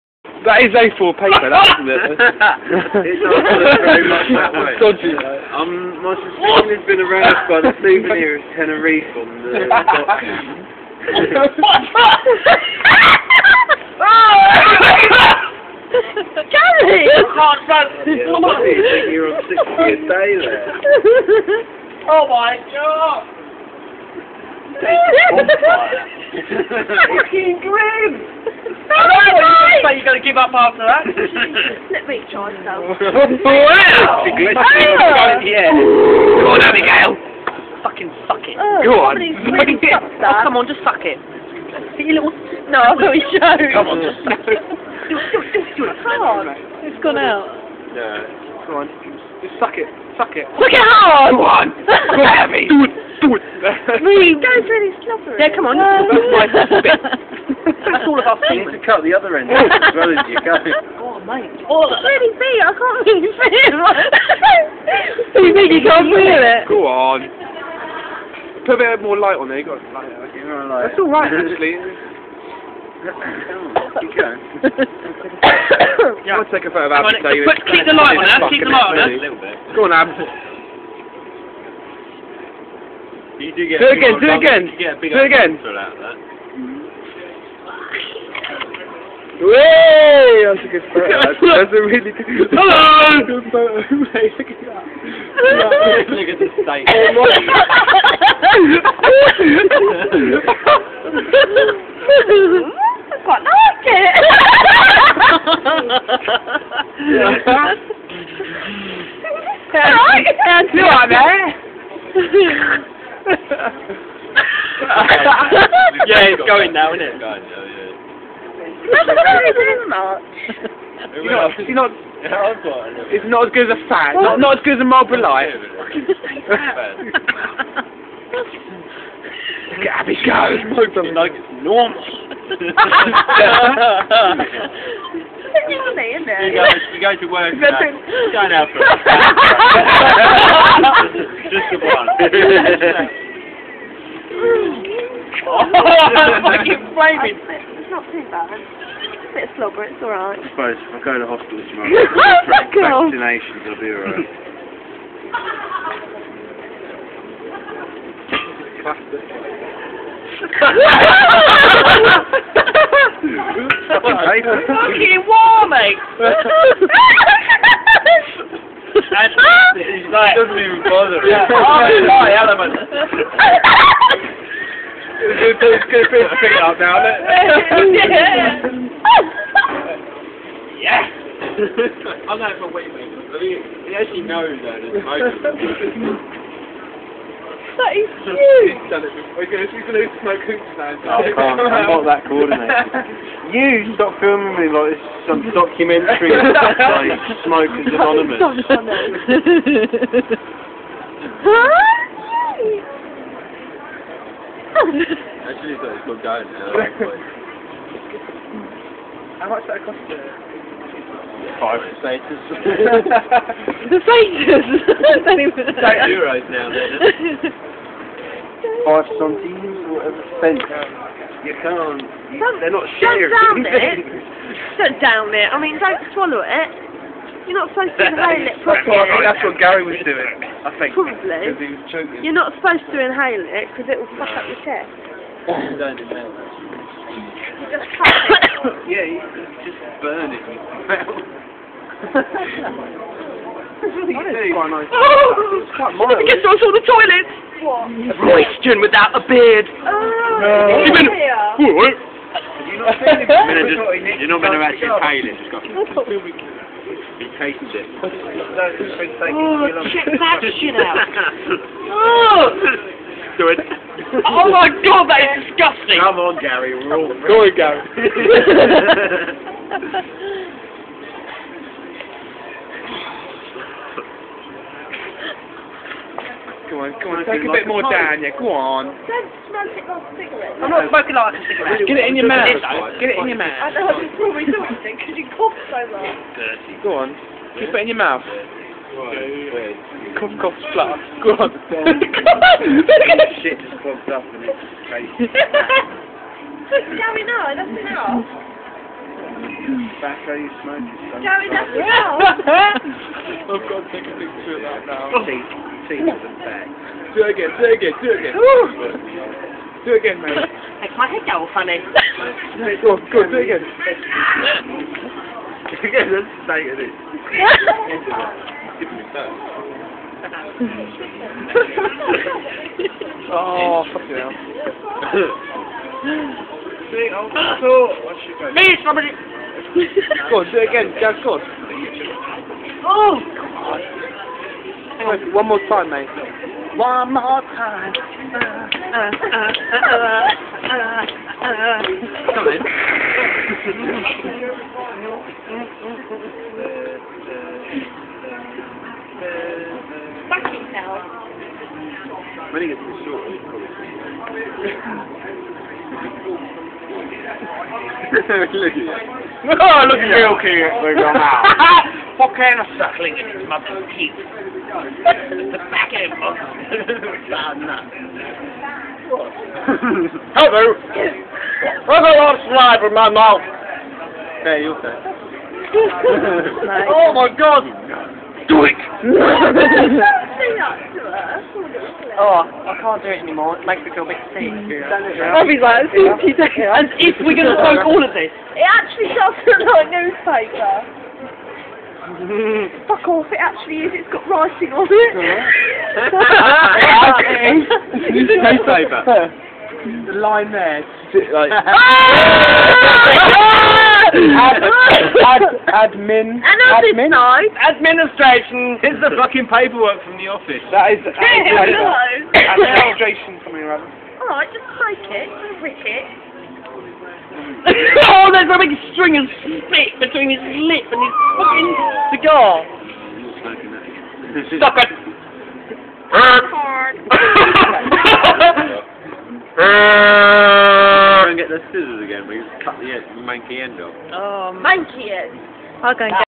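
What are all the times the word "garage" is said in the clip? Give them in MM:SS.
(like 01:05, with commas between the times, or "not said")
not said.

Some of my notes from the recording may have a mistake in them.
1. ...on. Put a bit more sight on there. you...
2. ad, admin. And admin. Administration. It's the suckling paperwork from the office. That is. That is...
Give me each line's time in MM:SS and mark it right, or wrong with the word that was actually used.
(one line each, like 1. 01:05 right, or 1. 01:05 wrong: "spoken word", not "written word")
1. 01:06 wrong: "light", not "sight"
2. 06:44 wrong: "fucking", not "suckling".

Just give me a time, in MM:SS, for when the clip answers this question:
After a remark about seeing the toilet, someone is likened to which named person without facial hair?
04:08.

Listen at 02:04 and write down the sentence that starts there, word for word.
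Not, not as good as a Marlboro Light.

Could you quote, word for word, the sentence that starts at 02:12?
you guys, you guys are working out.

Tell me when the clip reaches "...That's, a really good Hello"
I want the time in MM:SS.
01:30.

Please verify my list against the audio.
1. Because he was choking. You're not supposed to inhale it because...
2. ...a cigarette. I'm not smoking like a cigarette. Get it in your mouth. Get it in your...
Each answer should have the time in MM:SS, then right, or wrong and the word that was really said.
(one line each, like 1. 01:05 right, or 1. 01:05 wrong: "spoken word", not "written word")
1. 03:51 right
2. 04:40 right.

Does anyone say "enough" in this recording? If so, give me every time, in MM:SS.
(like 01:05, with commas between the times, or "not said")
04:57, 05:01.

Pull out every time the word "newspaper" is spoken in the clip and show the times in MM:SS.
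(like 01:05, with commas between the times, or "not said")
06:29, 06:38.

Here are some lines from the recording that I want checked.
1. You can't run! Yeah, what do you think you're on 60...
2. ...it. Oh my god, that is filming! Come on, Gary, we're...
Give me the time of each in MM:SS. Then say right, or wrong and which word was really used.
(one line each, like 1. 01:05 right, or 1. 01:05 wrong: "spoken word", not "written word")
1. 00:17 right
2. 04:23 wrong: "disgusting", not "filming".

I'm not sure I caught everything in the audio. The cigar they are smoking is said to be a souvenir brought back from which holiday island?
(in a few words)
Tenerife.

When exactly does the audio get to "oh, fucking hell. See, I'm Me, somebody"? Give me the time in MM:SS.
05:23.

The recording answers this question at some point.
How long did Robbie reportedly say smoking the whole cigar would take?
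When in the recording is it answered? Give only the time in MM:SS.
06:26.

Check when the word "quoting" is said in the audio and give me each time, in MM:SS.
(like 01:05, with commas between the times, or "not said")
not said.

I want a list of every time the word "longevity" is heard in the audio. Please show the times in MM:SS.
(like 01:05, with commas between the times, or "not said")
not said.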